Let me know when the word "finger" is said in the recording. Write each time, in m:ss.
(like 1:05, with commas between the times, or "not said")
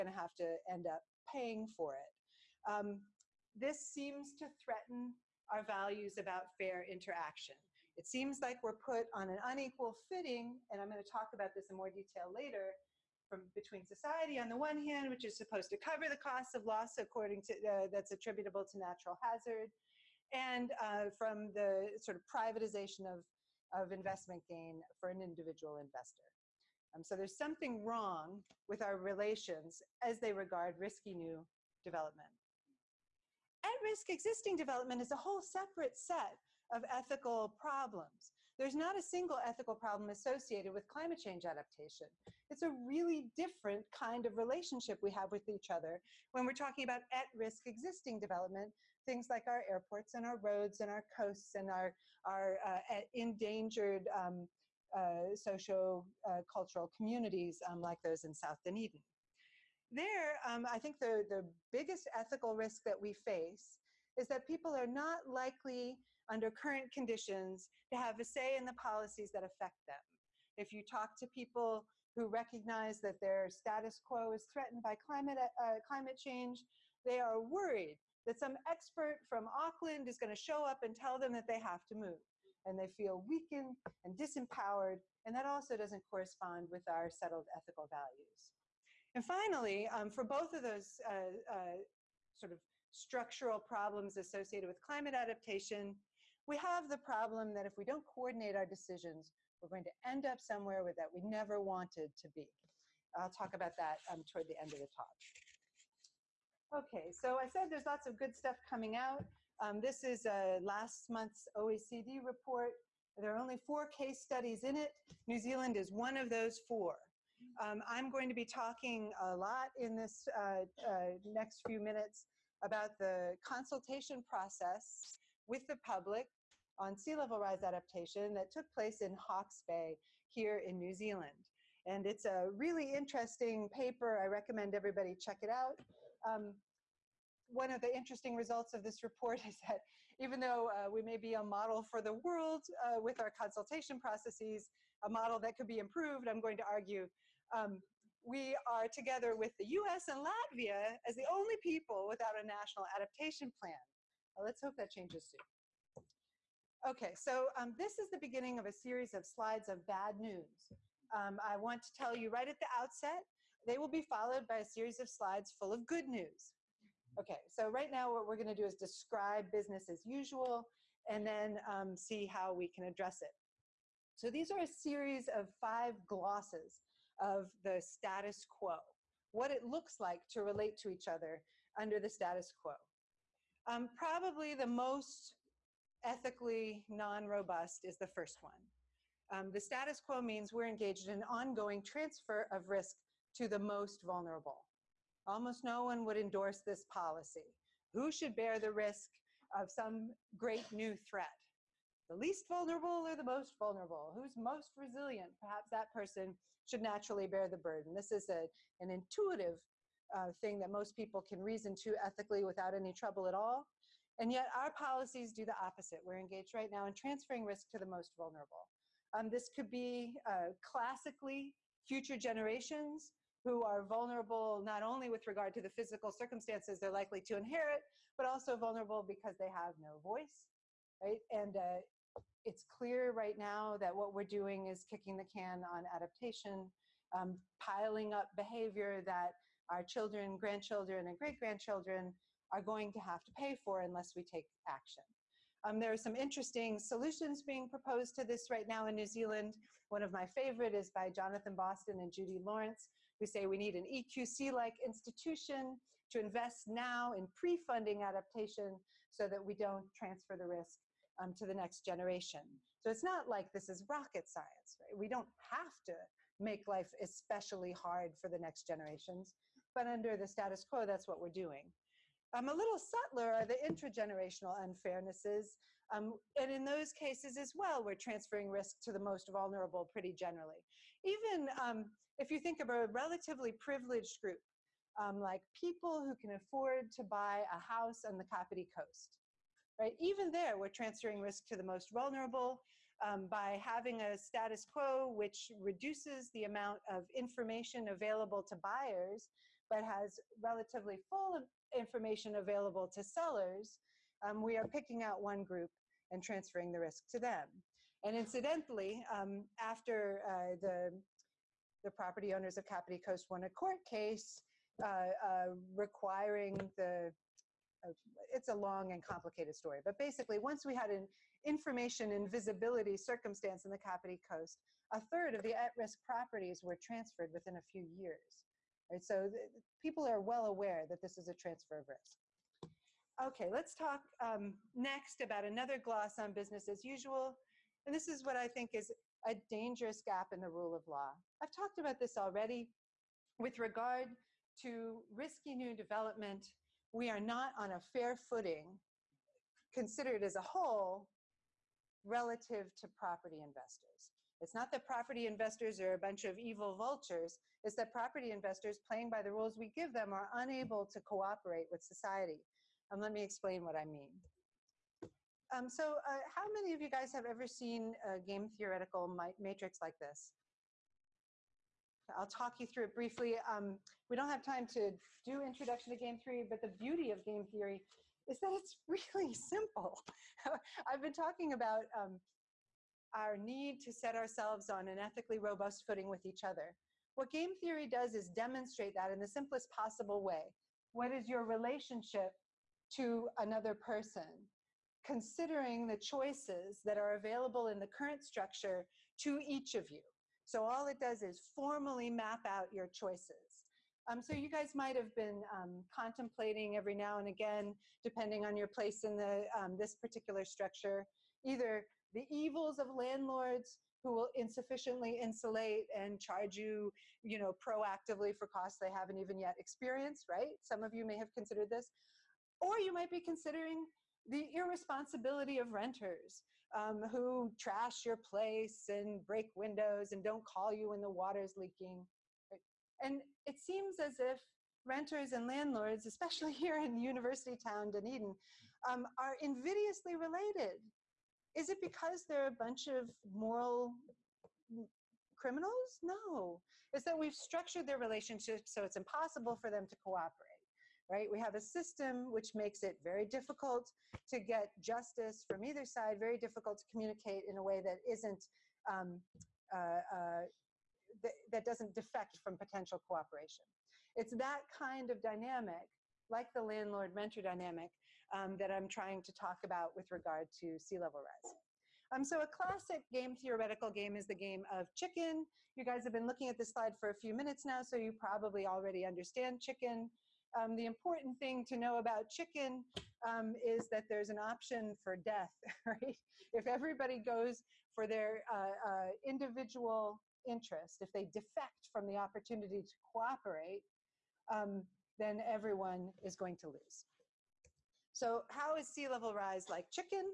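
not said.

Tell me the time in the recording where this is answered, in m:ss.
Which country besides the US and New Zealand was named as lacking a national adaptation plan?
2:30.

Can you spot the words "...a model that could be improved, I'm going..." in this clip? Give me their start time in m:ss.
2:25.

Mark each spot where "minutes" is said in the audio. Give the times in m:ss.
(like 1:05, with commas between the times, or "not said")
2:01, 7:57.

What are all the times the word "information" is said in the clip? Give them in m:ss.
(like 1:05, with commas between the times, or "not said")
4:57, 5:01, 5:21.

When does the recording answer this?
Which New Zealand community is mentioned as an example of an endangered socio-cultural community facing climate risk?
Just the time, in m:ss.
0:58.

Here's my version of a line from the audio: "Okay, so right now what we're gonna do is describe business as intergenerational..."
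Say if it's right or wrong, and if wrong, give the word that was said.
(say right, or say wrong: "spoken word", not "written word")
wrong: "usual", not "intergenerational".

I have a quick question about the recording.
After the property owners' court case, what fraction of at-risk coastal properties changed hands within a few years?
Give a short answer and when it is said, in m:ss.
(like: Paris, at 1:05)
A third, at 5:24.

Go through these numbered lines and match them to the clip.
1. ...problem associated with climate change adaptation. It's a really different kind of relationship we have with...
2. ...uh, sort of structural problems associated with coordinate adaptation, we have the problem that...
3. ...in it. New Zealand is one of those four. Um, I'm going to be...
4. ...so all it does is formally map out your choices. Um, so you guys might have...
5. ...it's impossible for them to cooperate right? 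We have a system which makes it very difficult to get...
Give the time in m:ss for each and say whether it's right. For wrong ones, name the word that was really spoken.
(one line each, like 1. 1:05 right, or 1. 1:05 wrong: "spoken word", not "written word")
1. 0:39 right
2. 1:31 wrong: "climate", not "coordinate"
3. 1:54 right
4. 6:40 right
5. 7:28 right.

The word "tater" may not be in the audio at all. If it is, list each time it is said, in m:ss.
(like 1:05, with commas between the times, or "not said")
not said.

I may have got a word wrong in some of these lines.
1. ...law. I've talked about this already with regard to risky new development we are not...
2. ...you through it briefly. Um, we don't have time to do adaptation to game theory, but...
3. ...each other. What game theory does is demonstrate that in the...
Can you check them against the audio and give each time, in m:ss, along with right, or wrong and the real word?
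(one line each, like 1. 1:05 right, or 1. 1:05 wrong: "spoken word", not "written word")
1. 5:40 right
2. 6:12 wrong: "introduction", not "adaptation"
3. 6:26 right.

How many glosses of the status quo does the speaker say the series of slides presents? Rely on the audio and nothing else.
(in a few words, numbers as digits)
5.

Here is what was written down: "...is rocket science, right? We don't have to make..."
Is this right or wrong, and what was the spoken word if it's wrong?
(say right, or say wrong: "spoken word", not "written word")
right.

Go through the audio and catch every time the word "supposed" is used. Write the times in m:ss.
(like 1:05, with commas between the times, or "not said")
0:15.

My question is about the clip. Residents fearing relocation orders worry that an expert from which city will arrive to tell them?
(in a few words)
Auckland.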